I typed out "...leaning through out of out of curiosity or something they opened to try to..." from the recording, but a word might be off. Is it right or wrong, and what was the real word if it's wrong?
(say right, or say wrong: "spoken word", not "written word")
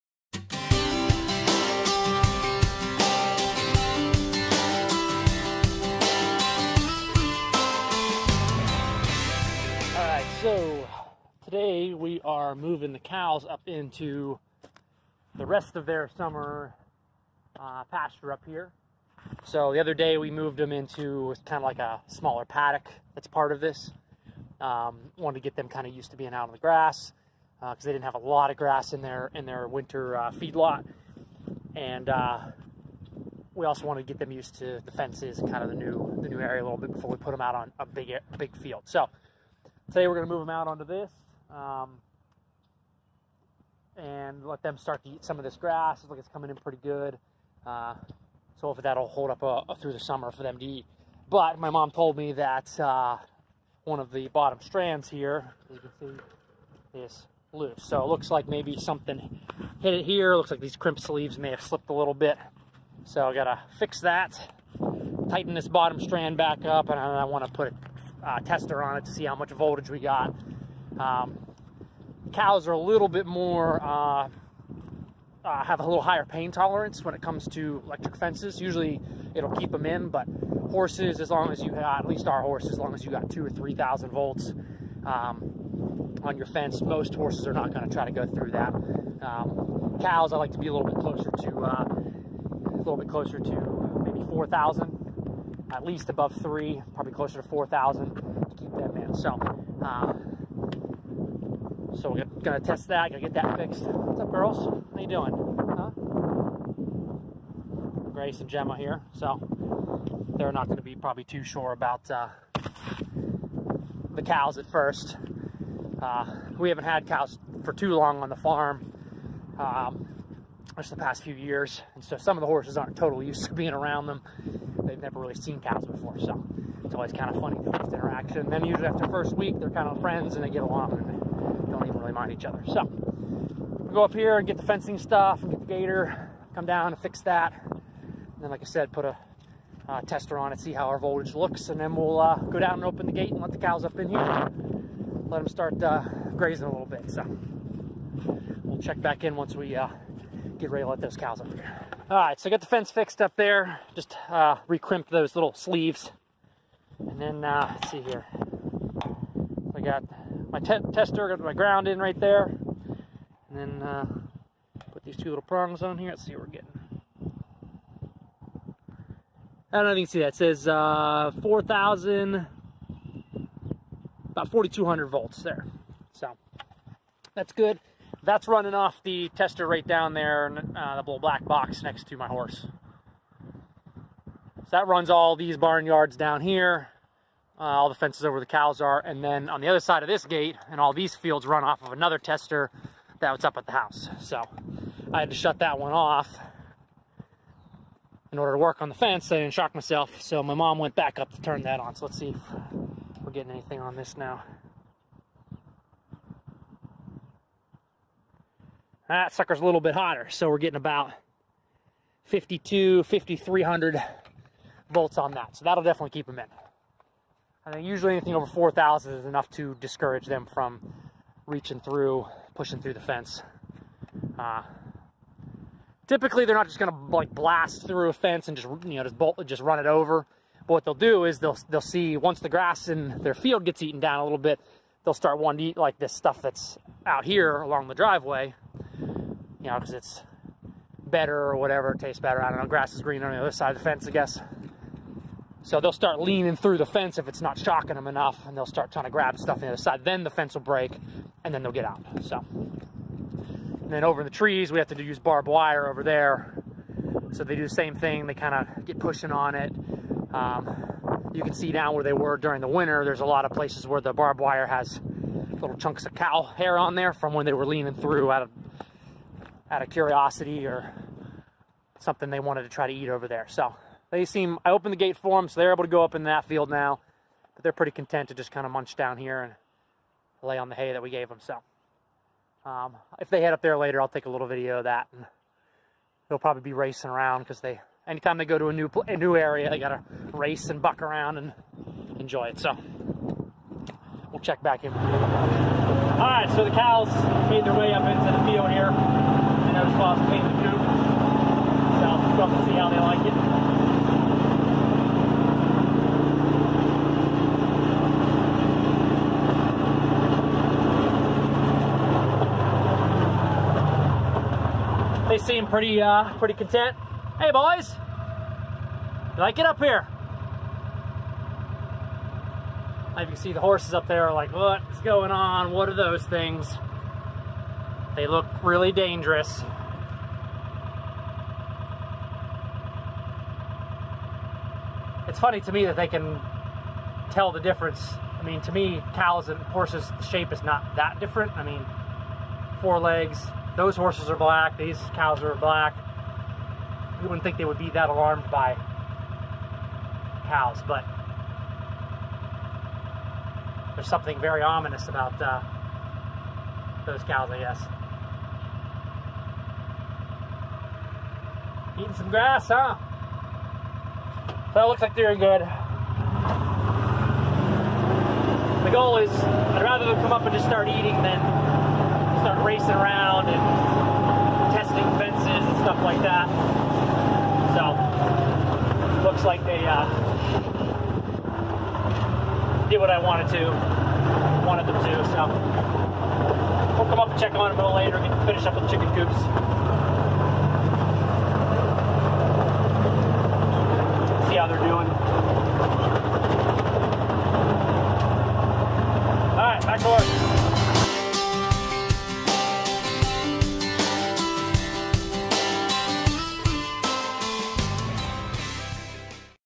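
wrong: "wanted", not "opened".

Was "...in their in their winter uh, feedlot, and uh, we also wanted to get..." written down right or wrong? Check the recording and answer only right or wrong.
right.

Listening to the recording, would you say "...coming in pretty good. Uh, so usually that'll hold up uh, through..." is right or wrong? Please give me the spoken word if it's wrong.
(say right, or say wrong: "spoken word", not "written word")
wrong: "hopefully", not "usually".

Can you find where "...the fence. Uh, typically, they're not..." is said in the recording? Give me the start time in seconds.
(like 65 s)
222 s.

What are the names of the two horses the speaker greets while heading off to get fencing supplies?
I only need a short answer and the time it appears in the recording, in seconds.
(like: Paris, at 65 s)
Grace and Gemma, at 108 s.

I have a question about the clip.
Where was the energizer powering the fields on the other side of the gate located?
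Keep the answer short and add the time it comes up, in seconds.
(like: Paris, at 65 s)
at the house, at 193 s.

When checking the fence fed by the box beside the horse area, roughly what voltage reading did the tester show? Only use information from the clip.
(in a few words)
4,200 volts.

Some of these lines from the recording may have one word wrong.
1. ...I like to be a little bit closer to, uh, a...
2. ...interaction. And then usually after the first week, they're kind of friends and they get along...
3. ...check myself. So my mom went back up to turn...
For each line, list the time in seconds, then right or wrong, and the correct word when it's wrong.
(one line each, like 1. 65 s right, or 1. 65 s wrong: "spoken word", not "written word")
1. 90 s right
2. 127 s right
3. 199 s wrong: "shock", not "check".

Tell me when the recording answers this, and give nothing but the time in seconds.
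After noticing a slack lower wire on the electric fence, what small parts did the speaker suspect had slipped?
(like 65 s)
60 s.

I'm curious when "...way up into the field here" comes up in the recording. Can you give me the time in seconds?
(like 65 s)
297 s.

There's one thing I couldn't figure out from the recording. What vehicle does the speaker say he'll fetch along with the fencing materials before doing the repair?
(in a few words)
gator.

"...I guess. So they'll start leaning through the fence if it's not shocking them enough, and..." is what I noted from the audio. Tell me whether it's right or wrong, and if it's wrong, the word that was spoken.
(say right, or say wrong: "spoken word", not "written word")
right.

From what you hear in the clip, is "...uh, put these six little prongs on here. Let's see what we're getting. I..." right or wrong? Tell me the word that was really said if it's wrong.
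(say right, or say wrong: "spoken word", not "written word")
wrong: "two", not "six".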